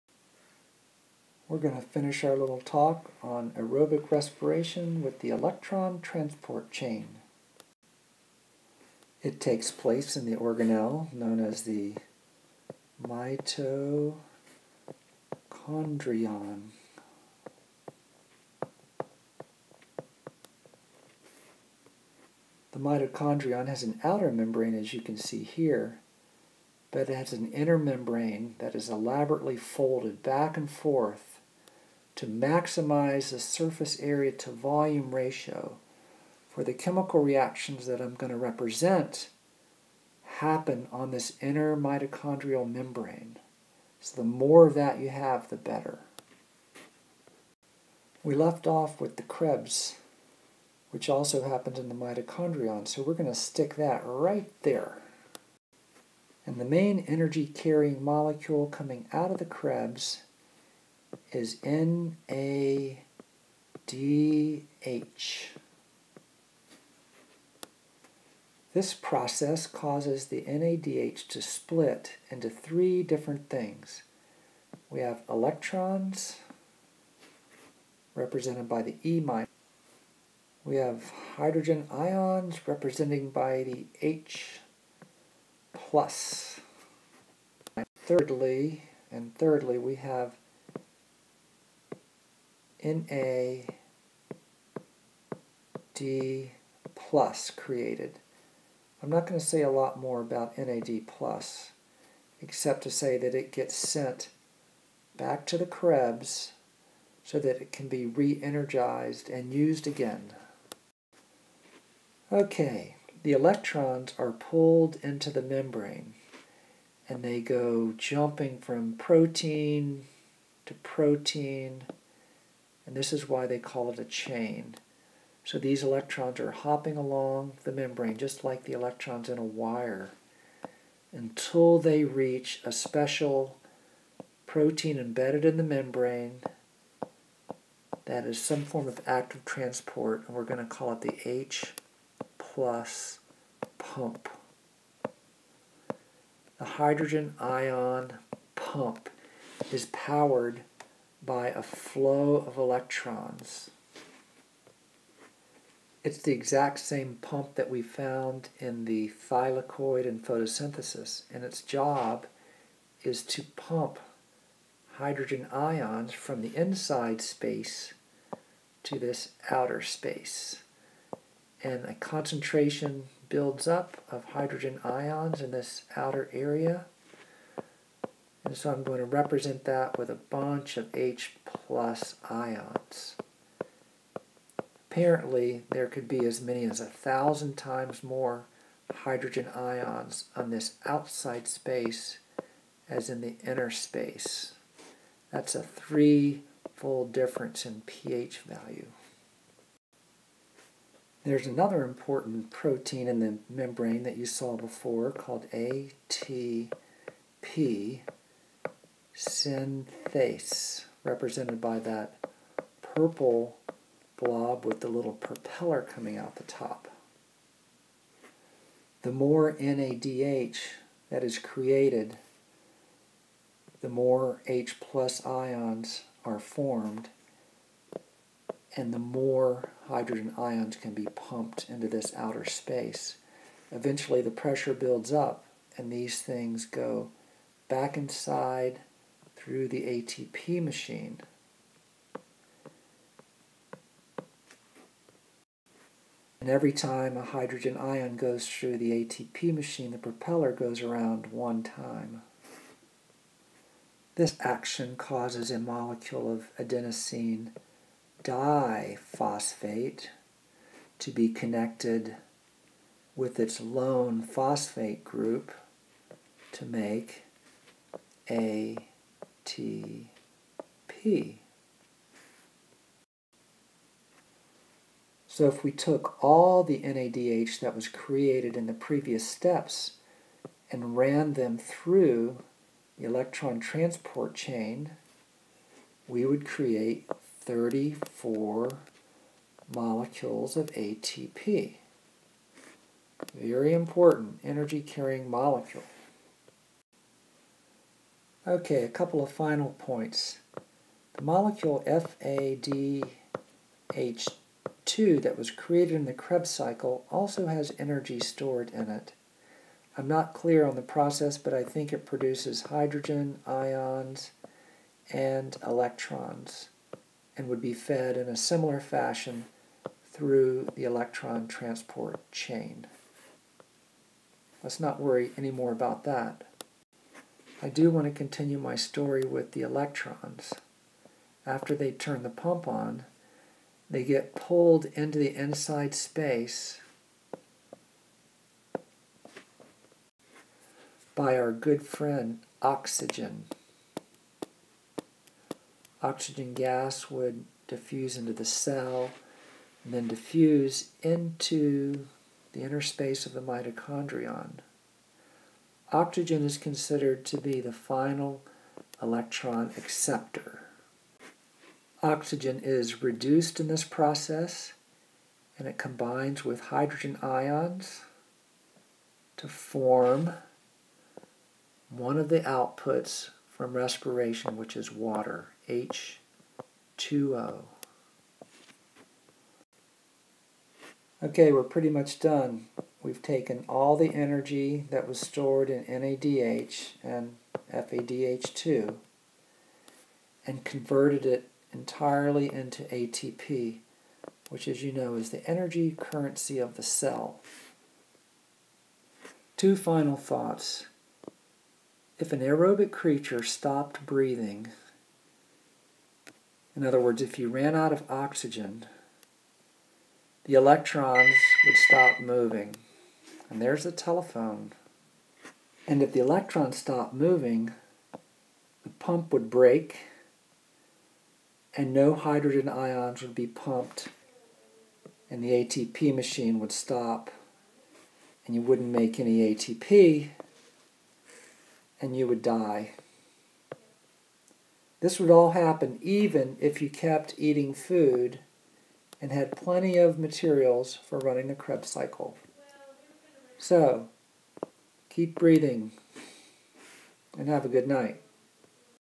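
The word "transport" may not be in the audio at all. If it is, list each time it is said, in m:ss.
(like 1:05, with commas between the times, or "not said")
0:05, 2:19, 4:43, 5:21.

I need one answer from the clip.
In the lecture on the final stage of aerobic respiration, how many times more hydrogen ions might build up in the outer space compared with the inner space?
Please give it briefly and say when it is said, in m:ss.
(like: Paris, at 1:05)
1000, at 3:06.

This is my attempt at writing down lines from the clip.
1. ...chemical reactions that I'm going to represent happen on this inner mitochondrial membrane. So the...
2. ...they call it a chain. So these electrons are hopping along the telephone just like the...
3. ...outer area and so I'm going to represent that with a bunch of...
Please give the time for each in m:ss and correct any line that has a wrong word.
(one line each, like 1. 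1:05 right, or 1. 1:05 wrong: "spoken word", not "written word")
1. 0:36 right
2. 2:03 wrong: "membrane", not "telephone"
3. 2:55 right.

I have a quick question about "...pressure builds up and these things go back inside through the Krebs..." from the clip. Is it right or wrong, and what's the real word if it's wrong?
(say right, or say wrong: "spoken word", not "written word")
wrong: "ATP", not "Krebs".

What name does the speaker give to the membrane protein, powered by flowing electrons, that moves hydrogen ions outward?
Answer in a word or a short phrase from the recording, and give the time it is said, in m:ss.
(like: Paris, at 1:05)
H plus pump, at 2:21.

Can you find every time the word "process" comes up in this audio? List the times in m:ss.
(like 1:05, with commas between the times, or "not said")
1:08, 5:10, 6:03.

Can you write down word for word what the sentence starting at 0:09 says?
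It takes place in the organelle known as the mitochondrion.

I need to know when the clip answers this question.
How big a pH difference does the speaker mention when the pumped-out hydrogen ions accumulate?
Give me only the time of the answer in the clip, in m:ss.
3:15.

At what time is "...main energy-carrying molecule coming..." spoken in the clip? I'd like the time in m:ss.
0:56.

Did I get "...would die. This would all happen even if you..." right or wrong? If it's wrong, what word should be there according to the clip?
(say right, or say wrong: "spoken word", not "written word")
right.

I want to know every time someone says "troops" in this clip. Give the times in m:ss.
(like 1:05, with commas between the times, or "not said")
not said.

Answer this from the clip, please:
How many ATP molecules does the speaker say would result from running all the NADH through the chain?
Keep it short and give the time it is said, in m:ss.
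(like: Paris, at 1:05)
34, at 4:47.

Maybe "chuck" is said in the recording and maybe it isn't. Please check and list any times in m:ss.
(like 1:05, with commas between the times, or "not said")
not said.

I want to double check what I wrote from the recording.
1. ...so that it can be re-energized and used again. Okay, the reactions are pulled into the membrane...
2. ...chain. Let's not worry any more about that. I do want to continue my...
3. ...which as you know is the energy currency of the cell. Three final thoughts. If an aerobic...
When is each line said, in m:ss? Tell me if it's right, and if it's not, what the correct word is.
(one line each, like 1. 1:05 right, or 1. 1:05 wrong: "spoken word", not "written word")
1. 1:47 wrong: "electrons", not "reactions"
2. 5:22 right
3. 6:34 wrong: "Two", not "Three".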